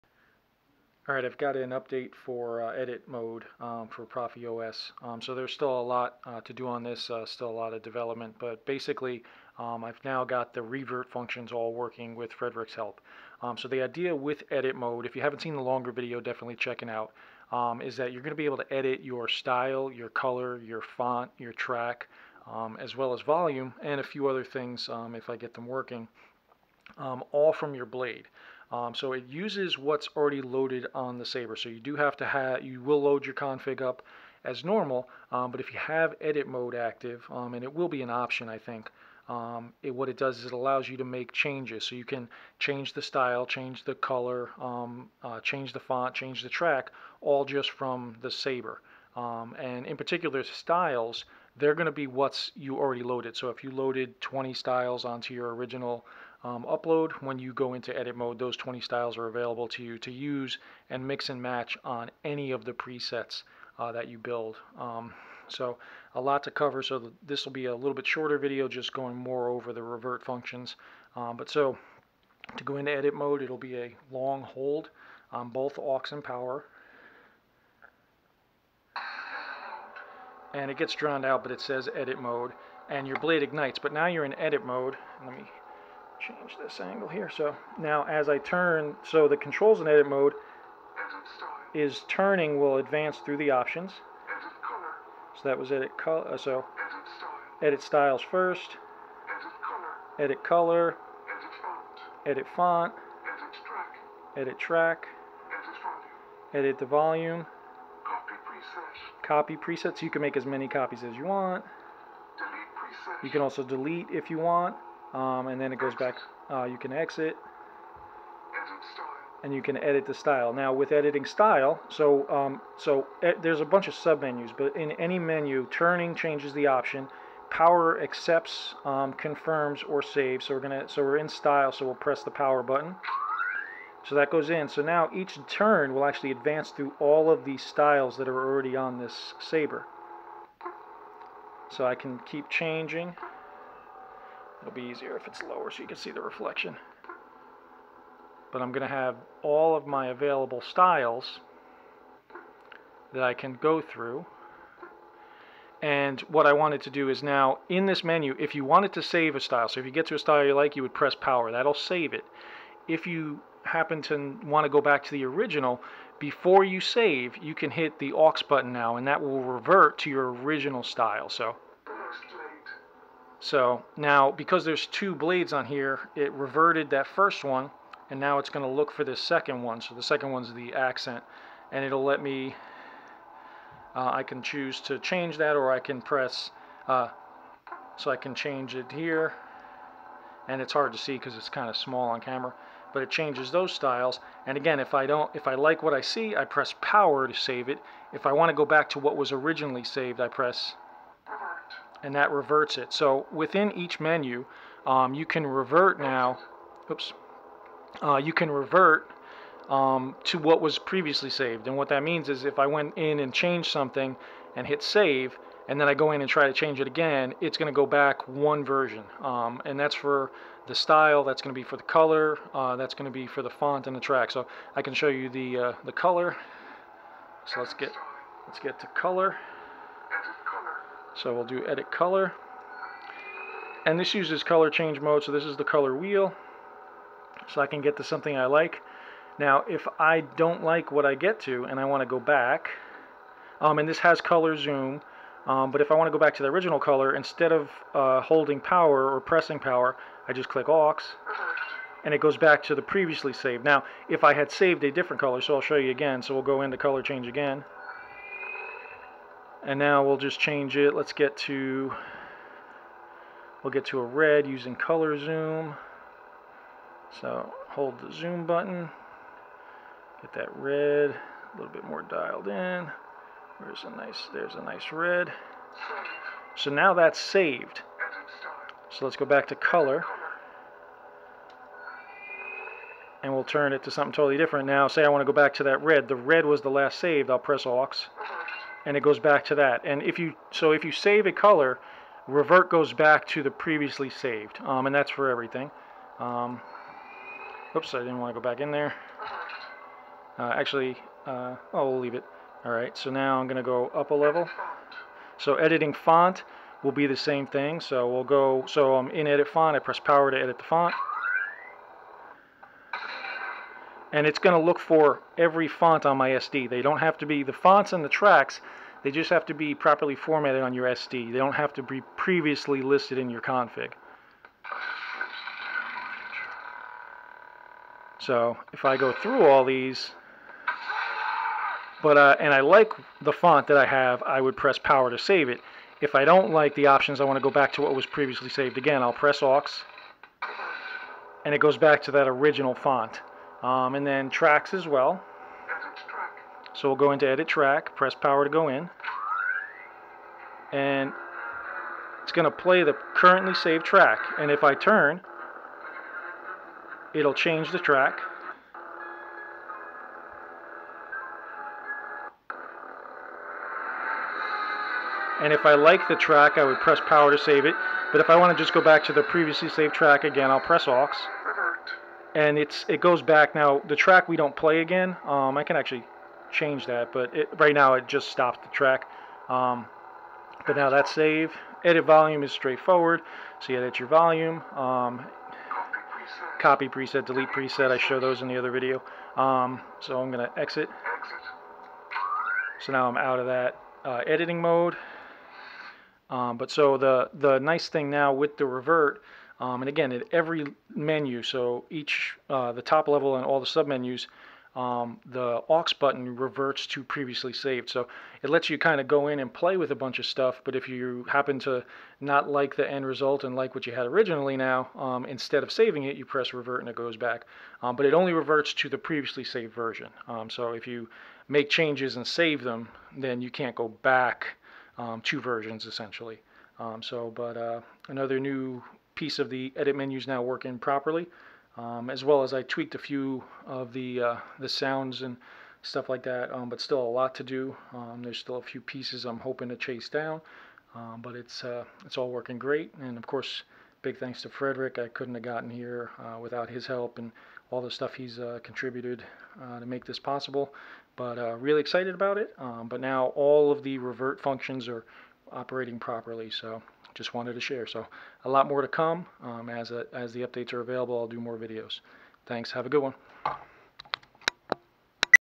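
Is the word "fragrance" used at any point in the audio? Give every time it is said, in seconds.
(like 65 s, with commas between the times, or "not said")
not said.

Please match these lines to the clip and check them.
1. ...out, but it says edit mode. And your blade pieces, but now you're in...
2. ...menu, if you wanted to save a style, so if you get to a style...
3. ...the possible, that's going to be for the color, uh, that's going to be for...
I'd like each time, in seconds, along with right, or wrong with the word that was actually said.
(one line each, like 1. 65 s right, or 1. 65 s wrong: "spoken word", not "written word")
1. 81 s wrong: "ignites", not "pieces"
2. 158 s right
3. 220 s wrong: "style", not "possible".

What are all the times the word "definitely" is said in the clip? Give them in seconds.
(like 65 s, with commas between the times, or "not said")
16 s.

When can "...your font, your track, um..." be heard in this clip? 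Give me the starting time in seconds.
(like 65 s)
20 s.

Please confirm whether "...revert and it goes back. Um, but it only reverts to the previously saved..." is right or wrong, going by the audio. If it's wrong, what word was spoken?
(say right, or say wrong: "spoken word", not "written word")
right.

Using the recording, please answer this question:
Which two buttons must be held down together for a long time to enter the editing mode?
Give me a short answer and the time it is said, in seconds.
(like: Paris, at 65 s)
aux and power, at 75 s.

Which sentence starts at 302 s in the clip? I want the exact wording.
All right, so now I'm going to go up a level.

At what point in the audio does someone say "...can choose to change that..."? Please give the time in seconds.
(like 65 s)
184 s.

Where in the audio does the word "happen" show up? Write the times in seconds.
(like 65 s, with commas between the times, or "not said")
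163 s, 411 s.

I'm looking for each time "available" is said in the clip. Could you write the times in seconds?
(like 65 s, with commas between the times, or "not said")
59 s, 150 s, 460 s.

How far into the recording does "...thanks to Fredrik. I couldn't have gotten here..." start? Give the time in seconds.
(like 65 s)
444 s.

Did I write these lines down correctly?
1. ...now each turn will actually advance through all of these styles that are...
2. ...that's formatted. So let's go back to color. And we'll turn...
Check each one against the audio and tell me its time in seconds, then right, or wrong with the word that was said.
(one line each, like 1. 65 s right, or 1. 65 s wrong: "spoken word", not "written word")
1. 134 s right
2. 276 s wrong: "saved", not "formatted".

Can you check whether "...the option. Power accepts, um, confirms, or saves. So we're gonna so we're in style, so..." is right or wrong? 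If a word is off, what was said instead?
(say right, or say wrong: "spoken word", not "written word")
right.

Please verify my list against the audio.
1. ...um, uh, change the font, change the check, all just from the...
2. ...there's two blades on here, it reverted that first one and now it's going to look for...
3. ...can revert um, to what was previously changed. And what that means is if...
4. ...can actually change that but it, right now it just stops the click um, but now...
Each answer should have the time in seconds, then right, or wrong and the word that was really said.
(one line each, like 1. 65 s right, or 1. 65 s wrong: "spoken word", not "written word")
1. 44 s wrong: "track", not "check"
2. 174 s right
3. 208 s wrong: "saved", not "changed"
4. 375 s wrong: "track", not "click".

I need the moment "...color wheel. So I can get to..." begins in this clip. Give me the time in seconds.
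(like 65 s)
235 s.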